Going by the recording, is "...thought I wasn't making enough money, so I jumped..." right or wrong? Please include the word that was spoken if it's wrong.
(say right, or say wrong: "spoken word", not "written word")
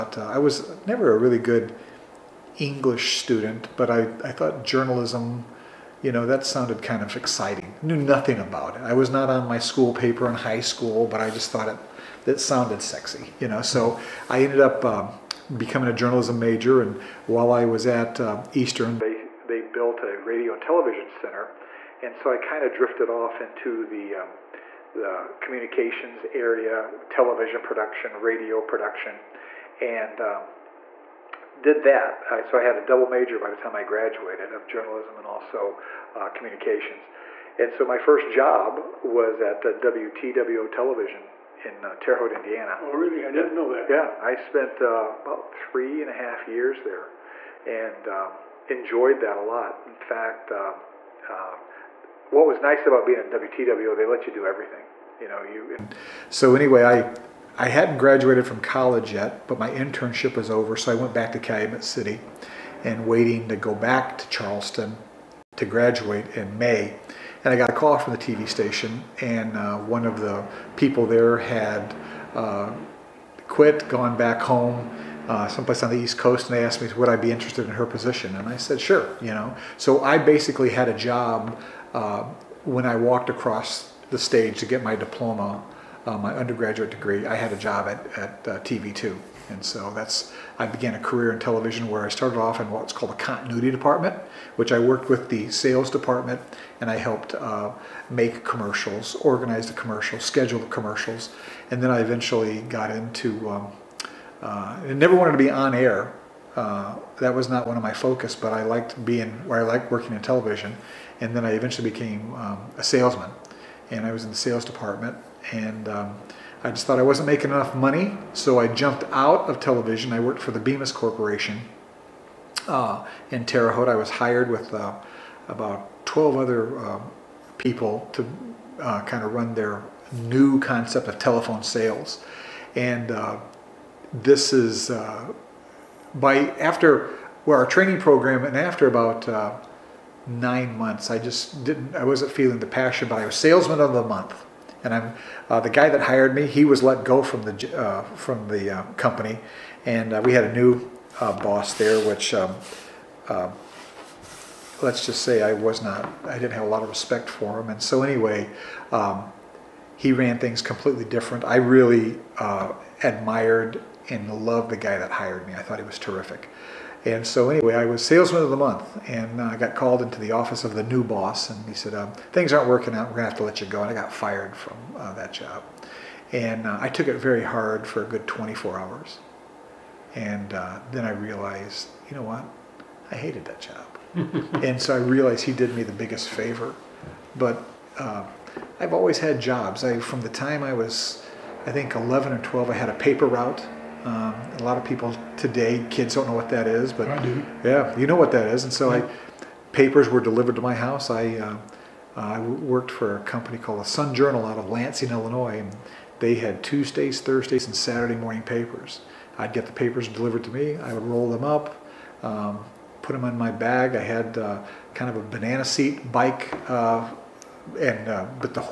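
right.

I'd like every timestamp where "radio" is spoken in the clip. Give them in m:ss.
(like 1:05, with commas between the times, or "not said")
0:20, 0:28.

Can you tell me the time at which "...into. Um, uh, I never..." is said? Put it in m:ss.
1:42.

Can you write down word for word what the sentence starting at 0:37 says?
And so my first job was at uh, WTWO Television in uh, Terre Haute, Indiana.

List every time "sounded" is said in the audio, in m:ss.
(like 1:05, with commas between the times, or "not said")
0:06, 0:12.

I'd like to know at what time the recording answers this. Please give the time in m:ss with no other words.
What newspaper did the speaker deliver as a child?
3:23.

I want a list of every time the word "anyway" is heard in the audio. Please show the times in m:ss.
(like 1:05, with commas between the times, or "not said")
0:56, 2:38, 2:47.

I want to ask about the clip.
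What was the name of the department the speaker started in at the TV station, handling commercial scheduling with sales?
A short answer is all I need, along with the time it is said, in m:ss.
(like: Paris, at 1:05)
continuity department, at 1:33.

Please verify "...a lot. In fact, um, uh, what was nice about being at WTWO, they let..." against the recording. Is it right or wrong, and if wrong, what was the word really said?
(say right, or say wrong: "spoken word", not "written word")
right.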